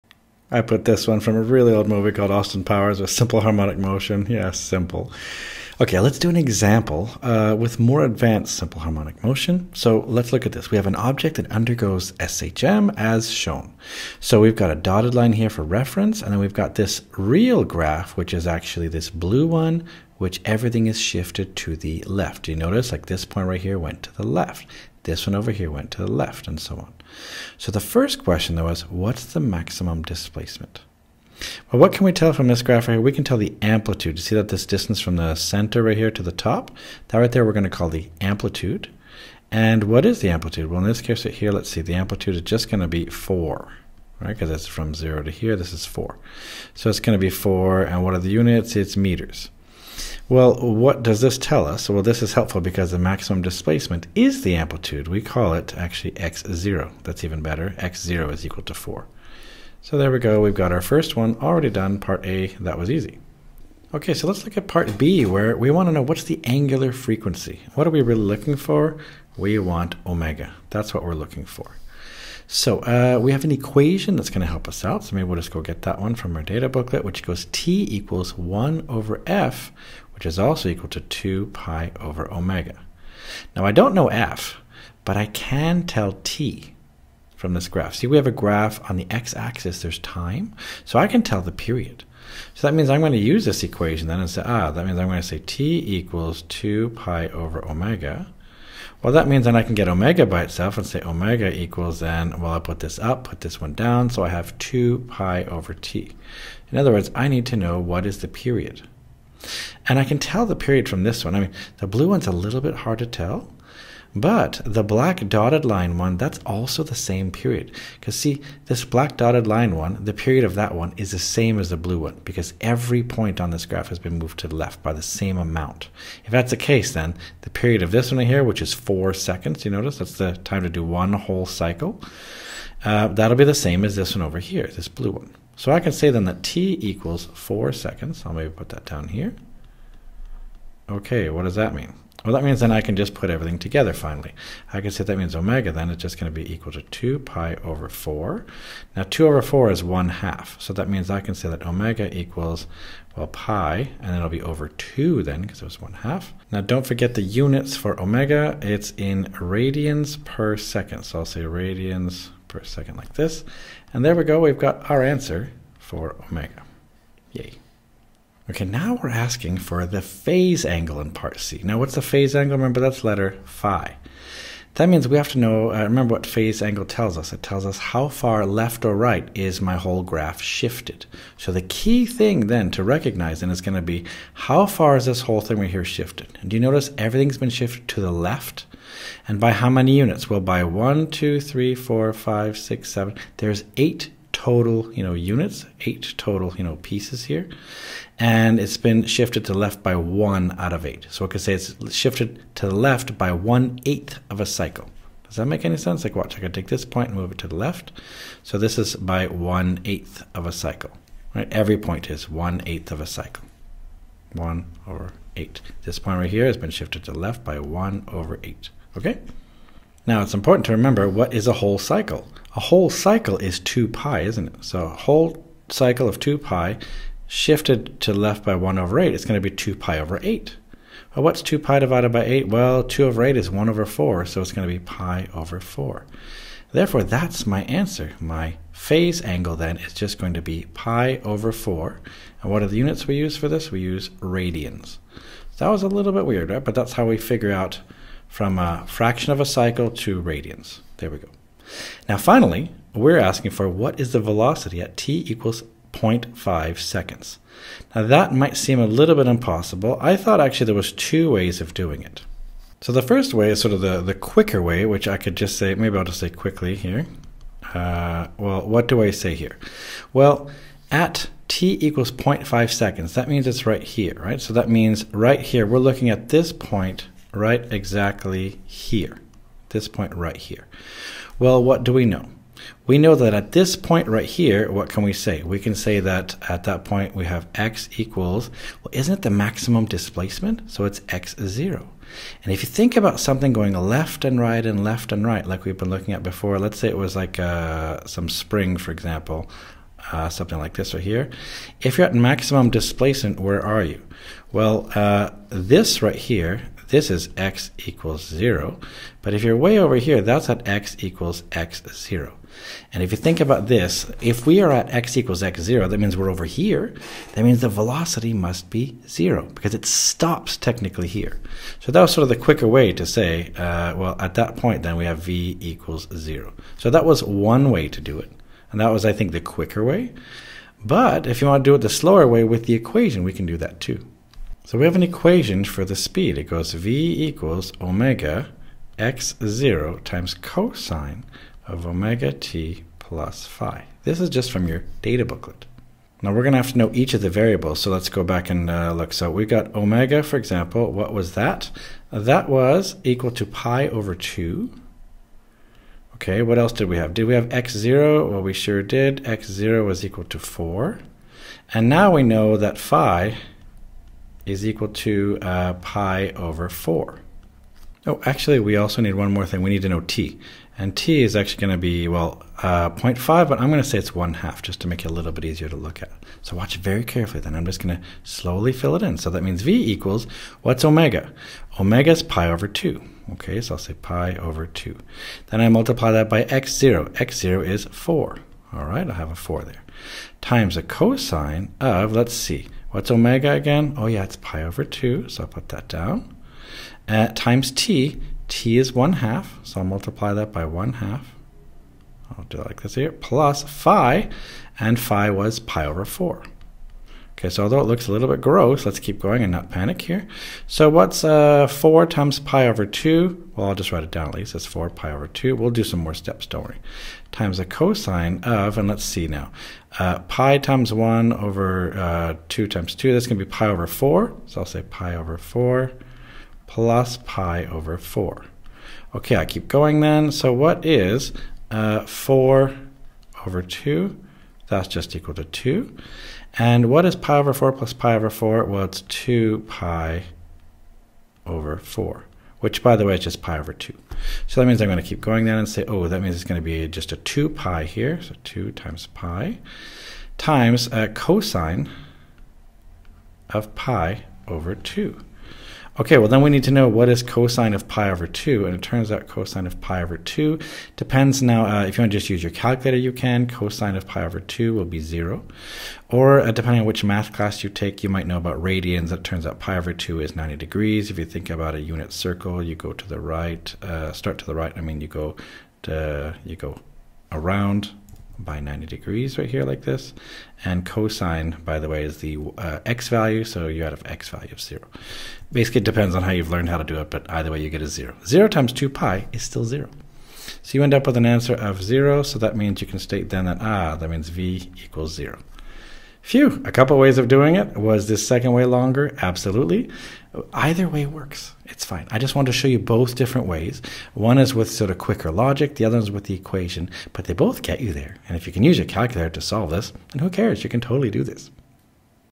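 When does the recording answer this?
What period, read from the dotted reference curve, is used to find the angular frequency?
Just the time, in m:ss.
2:17.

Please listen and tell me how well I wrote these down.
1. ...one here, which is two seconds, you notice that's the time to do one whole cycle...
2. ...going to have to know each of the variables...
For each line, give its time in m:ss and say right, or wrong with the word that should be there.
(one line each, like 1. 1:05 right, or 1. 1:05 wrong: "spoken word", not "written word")
1. 2:08 wrong: "four", not "two"
2. 5:46 right.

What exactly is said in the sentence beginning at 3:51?
Well, what's 2 pi divided by 8?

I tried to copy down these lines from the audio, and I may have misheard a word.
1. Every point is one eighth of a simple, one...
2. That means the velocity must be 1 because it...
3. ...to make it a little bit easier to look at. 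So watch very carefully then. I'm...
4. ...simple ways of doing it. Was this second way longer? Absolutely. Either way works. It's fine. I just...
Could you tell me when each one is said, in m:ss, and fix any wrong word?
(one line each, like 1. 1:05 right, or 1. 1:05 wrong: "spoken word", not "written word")
1. 3:31 wrong: "cycle", not "simple"
2. 5:17 wrong: "0", not "1"
3. 6:14 right
4. 8:16 wrong: "couple", not "simple".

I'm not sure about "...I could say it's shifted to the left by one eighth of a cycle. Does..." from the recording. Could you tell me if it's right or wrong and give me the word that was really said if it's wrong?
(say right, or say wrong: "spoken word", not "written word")
right.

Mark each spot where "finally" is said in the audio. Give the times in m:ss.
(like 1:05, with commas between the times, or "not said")
2:23, 4:12.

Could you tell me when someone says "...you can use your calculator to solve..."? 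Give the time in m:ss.
8:28.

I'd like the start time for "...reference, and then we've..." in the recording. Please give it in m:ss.
0:15.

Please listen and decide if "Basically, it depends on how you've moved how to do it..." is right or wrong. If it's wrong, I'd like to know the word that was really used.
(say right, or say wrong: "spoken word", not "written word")
wrong: "learned", not "moved".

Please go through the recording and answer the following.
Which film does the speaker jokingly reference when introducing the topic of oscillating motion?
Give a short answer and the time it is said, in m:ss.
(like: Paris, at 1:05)
Austin Powers, at 0:02.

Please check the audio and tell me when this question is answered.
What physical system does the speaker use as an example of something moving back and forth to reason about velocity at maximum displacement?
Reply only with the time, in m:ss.
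4:58.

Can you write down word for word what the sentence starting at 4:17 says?
Now, that might seem a little bit impossible.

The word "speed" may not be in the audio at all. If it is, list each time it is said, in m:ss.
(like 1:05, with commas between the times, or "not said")
5:35.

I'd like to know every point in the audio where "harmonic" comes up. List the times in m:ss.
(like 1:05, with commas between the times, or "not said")
0:03, 0:08.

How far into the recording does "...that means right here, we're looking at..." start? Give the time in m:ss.
4:34.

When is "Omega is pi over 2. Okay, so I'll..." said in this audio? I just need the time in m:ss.
6:21.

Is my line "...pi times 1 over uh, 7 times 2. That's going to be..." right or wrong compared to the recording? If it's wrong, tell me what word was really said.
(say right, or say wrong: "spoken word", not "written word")
wrong: "2", not "7".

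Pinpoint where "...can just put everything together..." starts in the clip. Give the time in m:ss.
2:22.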